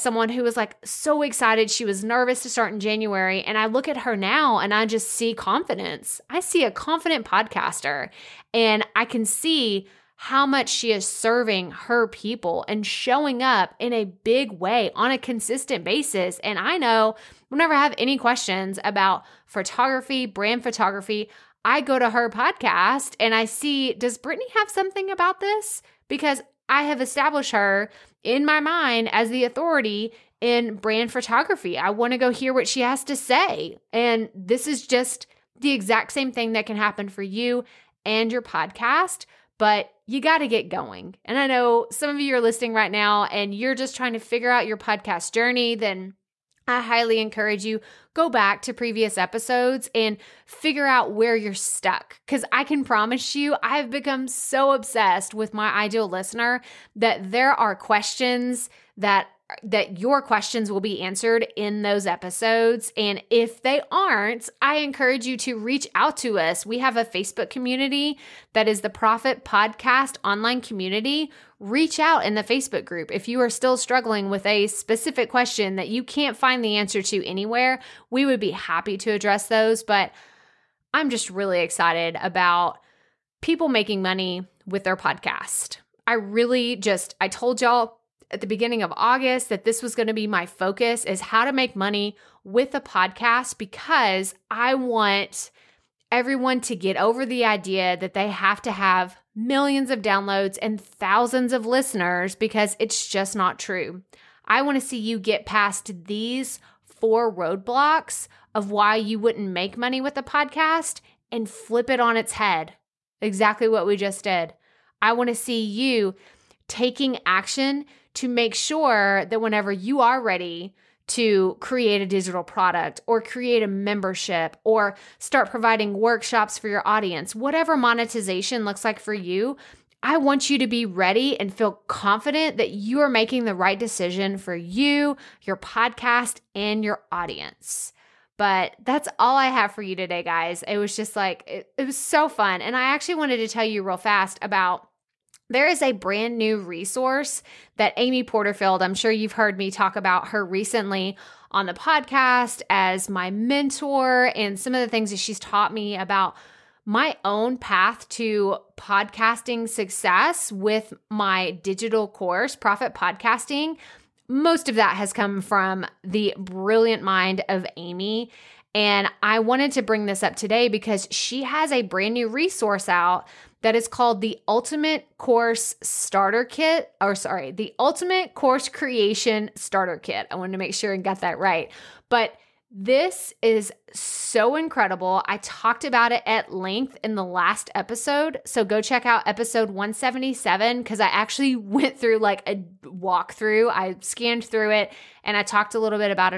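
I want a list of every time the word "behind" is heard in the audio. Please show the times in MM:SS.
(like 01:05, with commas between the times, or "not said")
not said.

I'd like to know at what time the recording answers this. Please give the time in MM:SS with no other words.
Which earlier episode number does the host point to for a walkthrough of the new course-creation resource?
03:09.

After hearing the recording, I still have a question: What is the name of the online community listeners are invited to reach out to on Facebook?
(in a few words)
Profit Podcast online community.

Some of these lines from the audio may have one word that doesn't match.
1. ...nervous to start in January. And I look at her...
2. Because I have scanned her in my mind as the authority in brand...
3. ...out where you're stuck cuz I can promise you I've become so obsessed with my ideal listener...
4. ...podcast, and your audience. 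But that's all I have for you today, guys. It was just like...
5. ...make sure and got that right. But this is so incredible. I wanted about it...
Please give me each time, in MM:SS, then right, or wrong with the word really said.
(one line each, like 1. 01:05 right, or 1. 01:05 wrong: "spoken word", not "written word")
1. 00:02 right
2. 00:26 wrong: "established", not "scanned"
3. 00:50 right
4. 02:15 right
5. 03:00 wrong: "talked", not "wanted".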